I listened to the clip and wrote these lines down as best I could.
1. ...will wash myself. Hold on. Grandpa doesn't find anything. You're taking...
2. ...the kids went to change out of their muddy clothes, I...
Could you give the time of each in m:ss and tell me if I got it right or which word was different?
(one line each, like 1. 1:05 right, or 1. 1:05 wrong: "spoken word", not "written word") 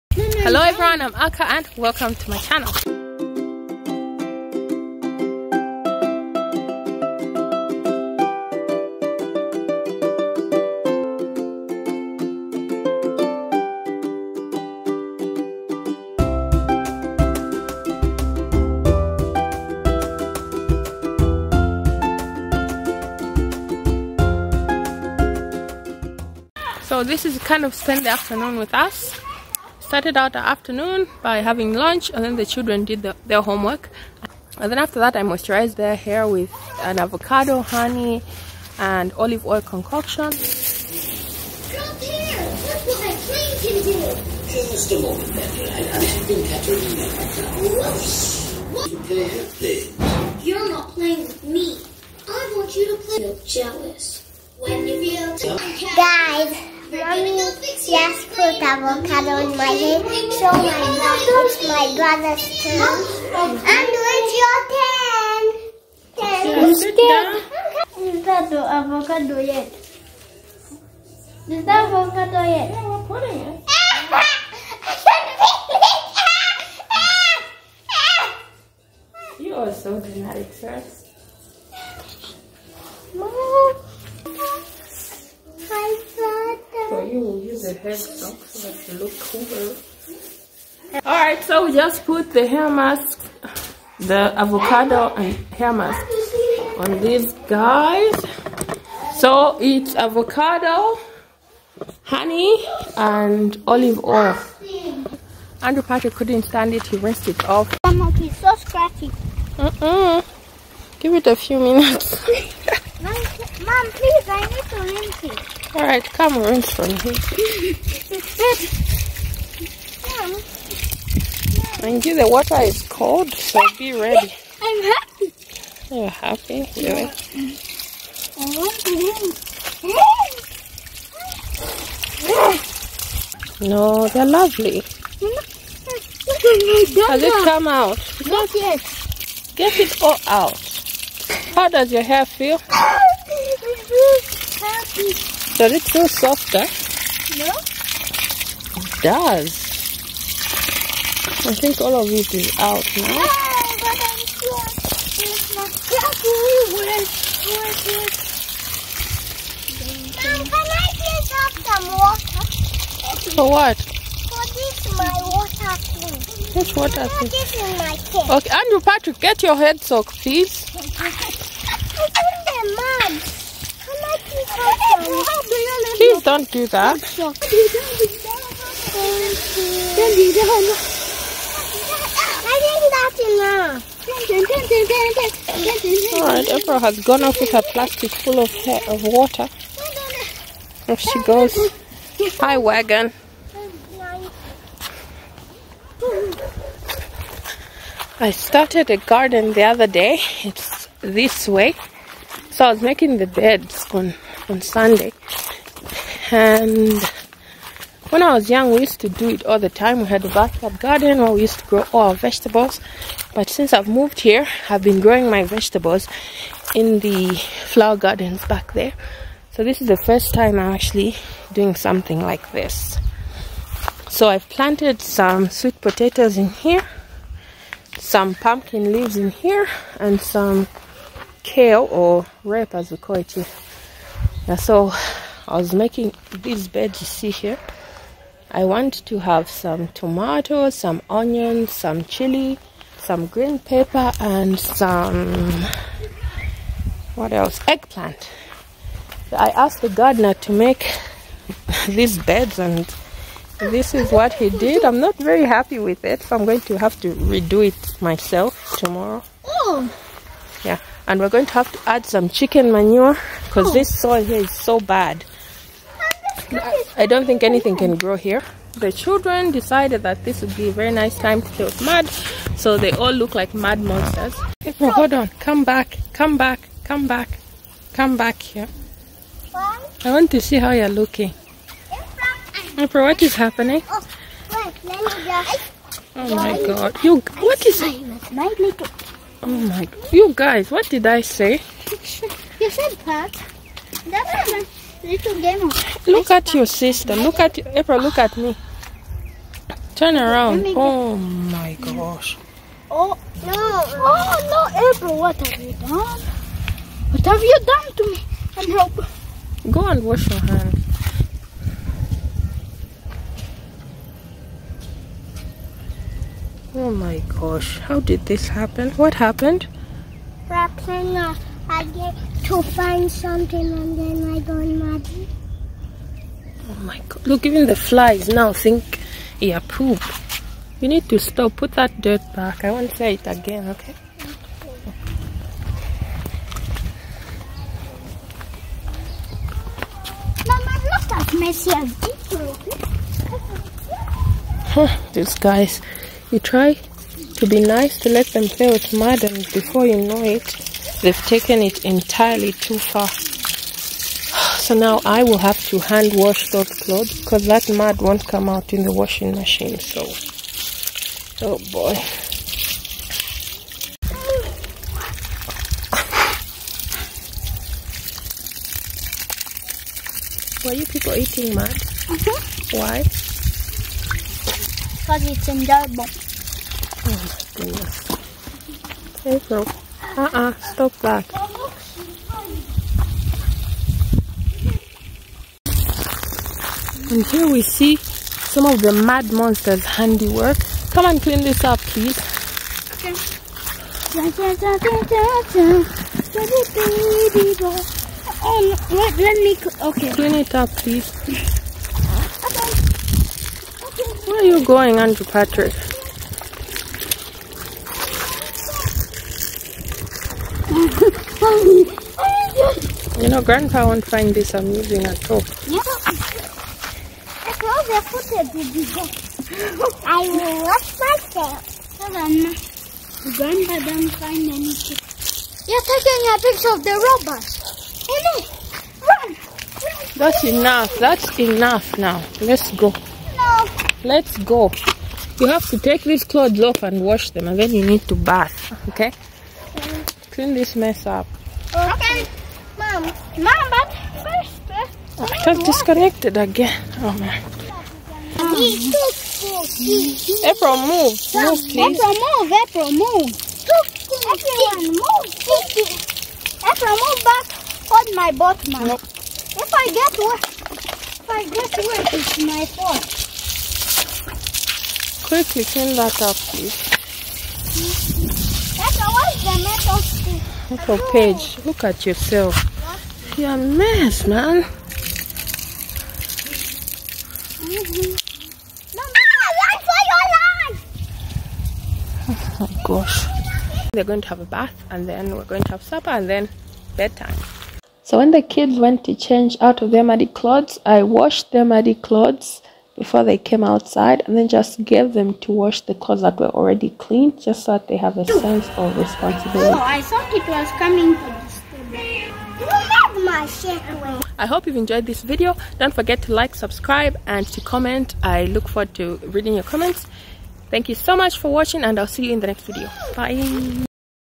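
1. 7:00 right
2. 8:08 right.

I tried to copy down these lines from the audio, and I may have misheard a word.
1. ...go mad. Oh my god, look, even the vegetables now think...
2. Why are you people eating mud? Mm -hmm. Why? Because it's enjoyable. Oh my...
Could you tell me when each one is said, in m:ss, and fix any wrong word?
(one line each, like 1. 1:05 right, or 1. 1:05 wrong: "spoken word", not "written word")
1. 5:24 wrong: "flies", not "vegetables"
2. 6:10 right.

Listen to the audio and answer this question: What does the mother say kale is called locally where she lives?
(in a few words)
rape.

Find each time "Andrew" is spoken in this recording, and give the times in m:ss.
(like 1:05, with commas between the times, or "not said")
1:45, 2:48, 6:44.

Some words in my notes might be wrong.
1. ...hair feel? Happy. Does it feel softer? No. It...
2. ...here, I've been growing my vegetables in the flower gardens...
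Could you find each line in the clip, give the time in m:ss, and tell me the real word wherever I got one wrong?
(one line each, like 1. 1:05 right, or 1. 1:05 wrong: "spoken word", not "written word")
1. 2:22 right
2. 3:34 right.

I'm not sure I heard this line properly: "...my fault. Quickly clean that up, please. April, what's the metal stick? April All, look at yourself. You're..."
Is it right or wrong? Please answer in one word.
wrong.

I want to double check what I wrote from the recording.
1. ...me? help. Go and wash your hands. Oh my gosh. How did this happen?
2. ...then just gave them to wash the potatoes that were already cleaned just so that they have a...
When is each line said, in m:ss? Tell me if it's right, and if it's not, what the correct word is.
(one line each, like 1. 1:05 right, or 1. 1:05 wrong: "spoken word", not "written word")
1. 5:08 right
2. 8:14 wrong: "clothes", not "potatoes".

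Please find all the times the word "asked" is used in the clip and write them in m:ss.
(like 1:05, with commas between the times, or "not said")
4:09.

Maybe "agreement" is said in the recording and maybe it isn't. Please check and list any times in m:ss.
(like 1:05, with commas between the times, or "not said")
not said.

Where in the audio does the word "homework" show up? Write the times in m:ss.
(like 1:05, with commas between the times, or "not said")
0:33.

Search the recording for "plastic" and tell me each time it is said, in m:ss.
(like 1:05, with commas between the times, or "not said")
3:07.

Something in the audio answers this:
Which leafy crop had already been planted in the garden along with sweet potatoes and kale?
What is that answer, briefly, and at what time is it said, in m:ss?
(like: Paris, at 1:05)
pumpkin leaves, at 3:48.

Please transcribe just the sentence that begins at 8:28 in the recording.
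I look forward to reading your comments.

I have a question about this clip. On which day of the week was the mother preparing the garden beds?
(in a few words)
Sunday.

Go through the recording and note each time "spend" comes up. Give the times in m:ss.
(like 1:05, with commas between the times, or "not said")
0:27.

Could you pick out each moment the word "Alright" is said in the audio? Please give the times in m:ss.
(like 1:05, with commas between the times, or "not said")
1:31, 3:06.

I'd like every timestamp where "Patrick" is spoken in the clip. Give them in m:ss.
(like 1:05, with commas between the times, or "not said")
1:45, 2:48, 6:45.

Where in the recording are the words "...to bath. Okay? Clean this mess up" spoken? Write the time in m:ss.
7:18.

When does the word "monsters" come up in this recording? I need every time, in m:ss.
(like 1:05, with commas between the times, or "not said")
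4:33, 6:29.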